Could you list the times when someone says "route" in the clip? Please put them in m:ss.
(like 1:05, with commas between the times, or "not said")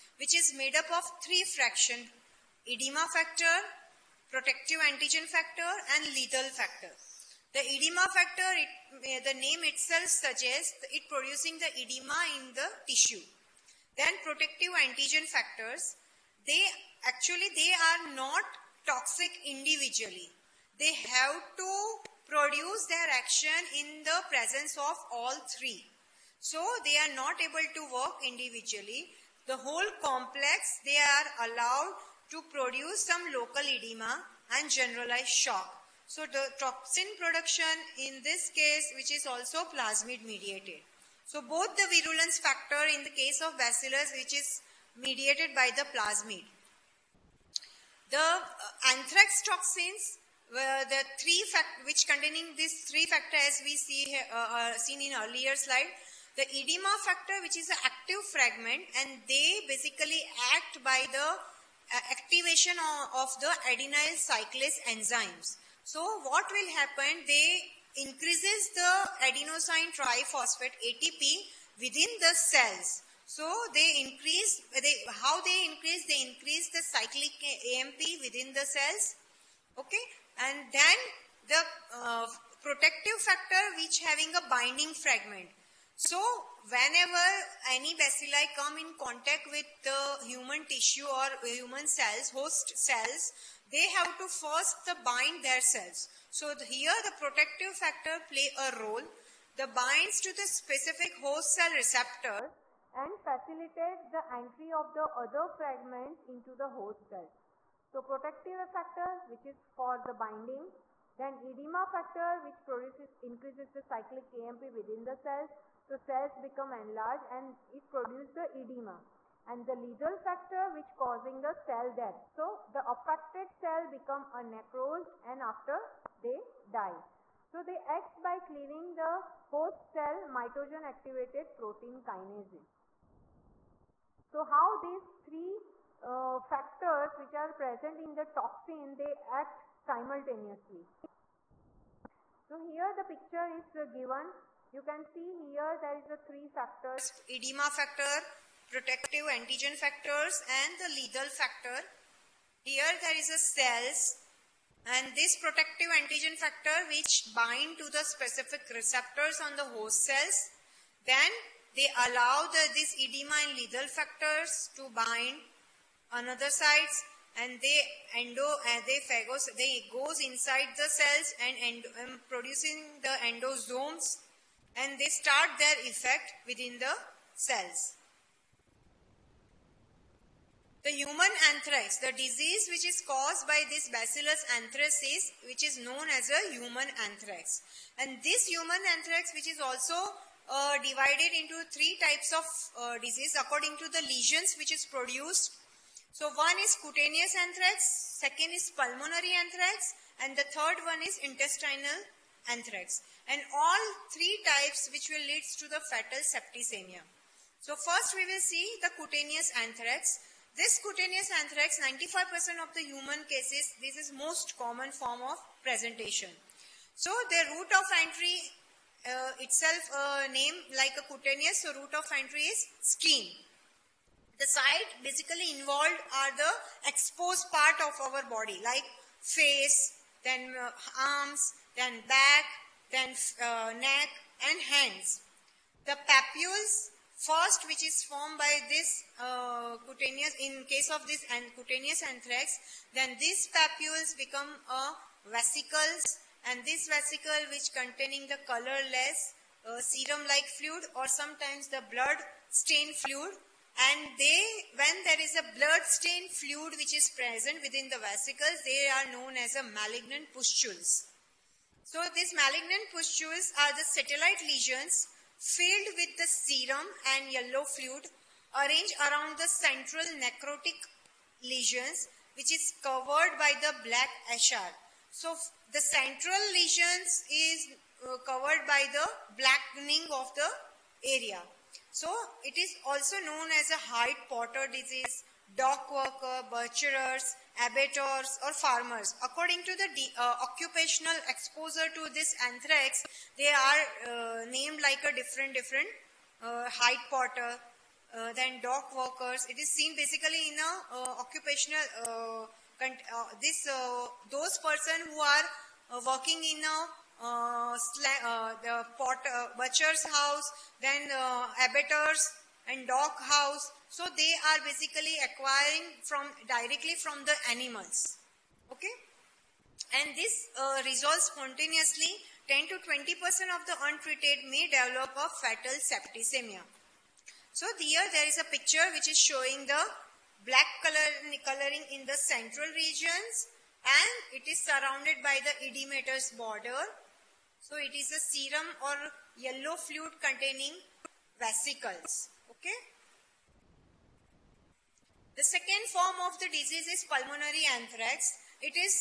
3:37, 3:41.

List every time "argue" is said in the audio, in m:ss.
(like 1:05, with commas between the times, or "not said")
not said.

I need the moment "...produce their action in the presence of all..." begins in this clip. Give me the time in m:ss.
0:22.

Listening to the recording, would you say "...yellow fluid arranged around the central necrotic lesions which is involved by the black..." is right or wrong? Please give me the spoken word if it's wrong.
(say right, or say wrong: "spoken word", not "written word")
wrong: "covered", not "involved".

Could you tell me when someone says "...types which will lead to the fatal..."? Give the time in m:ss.
3:24.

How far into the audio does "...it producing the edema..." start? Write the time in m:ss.
0:10.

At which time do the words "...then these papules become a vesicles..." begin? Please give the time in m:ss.
4:02.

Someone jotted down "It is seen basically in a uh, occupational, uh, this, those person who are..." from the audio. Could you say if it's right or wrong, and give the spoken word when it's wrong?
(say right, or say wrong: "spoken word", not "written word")
right.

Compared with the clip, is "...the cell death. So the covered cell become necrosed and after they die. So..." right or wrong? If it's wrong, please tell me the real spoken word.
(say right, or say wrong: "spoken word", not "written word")
wrong: "affected", not "covered".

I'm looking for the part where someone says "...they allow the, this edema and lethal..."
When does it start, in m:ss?
2:41.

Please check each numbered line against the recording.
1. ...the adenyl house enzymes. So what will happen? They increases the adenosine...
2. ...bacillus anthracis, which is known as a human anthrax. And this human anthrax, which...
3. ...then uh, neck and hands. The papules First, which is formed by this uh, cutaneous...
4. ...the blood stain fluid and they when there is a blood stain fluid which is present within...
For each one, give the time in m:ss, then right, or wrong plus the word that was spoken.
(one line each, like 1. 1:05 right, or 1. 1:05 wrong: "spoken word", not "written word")
1. 1:03 wrong: "cyclase", not "house"
2. 3:03 right
3. 3:52 right
4. 4:11 right.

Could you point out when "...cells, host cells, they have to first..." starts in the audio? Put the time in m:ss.
1:31.